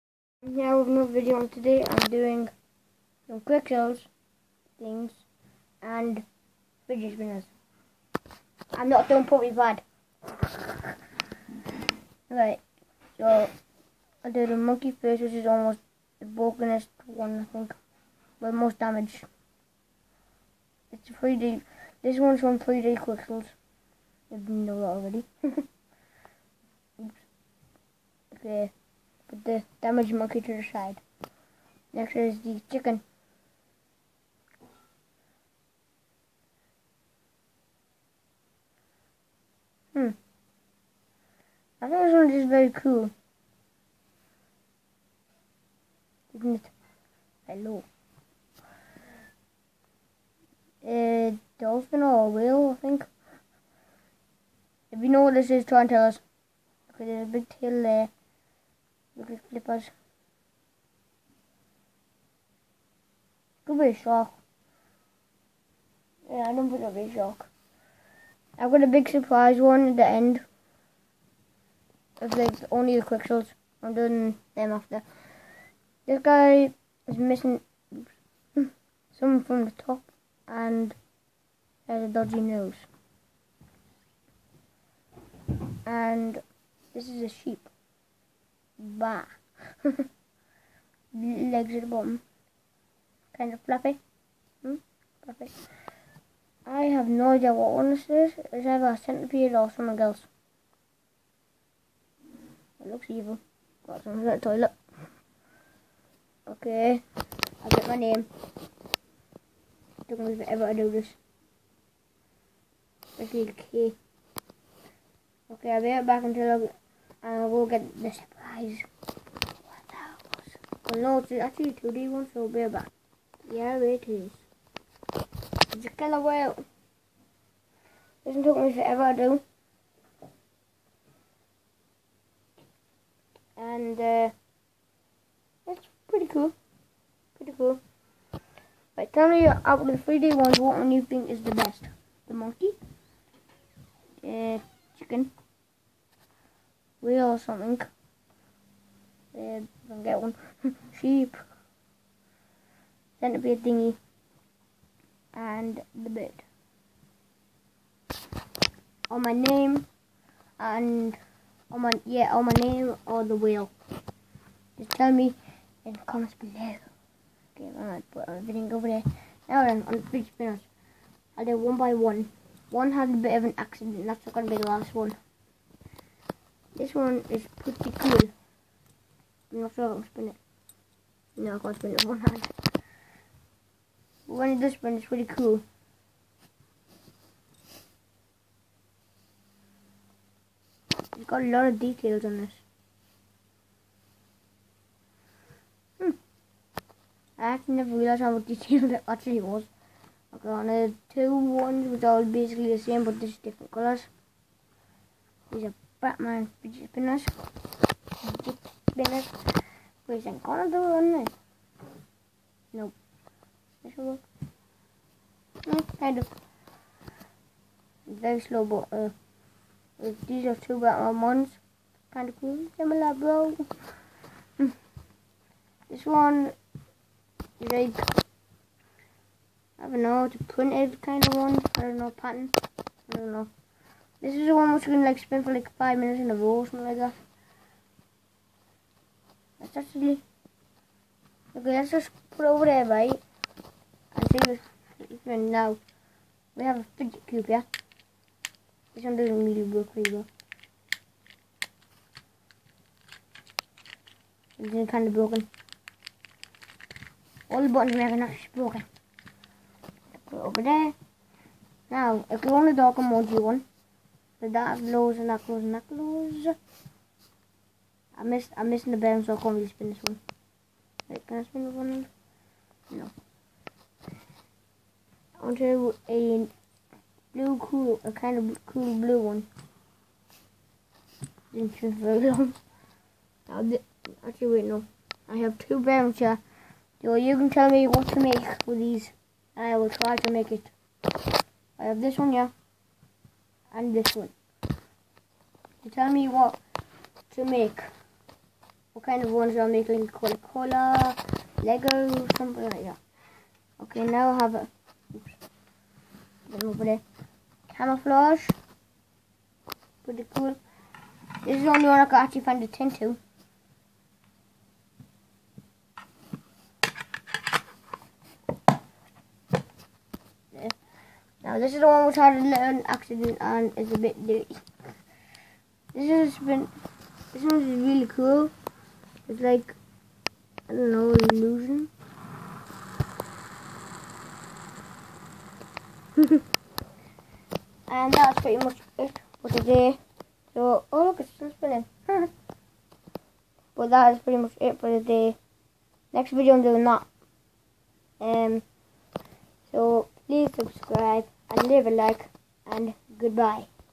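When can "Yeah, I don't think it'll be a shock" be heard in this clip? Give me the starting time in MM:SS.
01:06.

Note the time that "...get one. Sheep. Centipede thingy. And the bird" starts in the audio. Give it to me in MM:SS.
02:30.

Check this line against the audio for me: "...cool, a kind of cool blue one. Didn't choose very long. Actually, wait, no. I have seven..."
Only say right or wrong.
wrong.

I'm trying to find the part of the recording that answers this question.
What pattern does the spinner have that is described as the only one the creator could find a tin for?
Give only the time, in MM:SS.
05:07.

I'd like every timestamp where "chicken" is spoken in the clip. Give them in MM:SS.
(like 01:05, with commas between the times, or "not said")
00:32, 02:24.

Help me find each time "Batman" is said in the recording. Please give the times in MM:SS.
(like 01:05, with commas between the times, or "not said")
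03:25, 03:40.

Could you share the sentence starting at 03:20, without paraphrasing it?
I got the two ones which are basically the same but just different colours.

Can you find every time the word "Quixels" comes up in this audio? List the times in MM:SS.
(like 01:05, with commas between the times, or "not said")
00:03, 00:23, 01:13.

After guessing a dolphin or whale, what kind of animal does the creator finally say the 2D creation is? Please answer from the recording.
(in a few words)
killer whale.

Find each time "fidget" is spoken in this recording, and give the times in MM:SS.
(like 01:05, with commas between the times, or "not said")
00:06, 03:26, 04:06.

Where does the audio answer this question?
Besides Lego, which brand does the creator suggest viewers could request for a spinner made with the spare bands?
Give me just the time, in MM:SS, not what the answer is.
05:00.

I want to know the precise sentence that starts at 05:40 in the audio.
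So, oh look, it's still spinning.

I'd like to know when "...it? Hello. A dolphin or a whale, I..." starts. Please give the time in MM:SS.
00:46.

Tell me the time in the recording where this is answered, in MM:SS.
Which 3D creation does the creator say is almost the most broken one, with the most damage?
00:14.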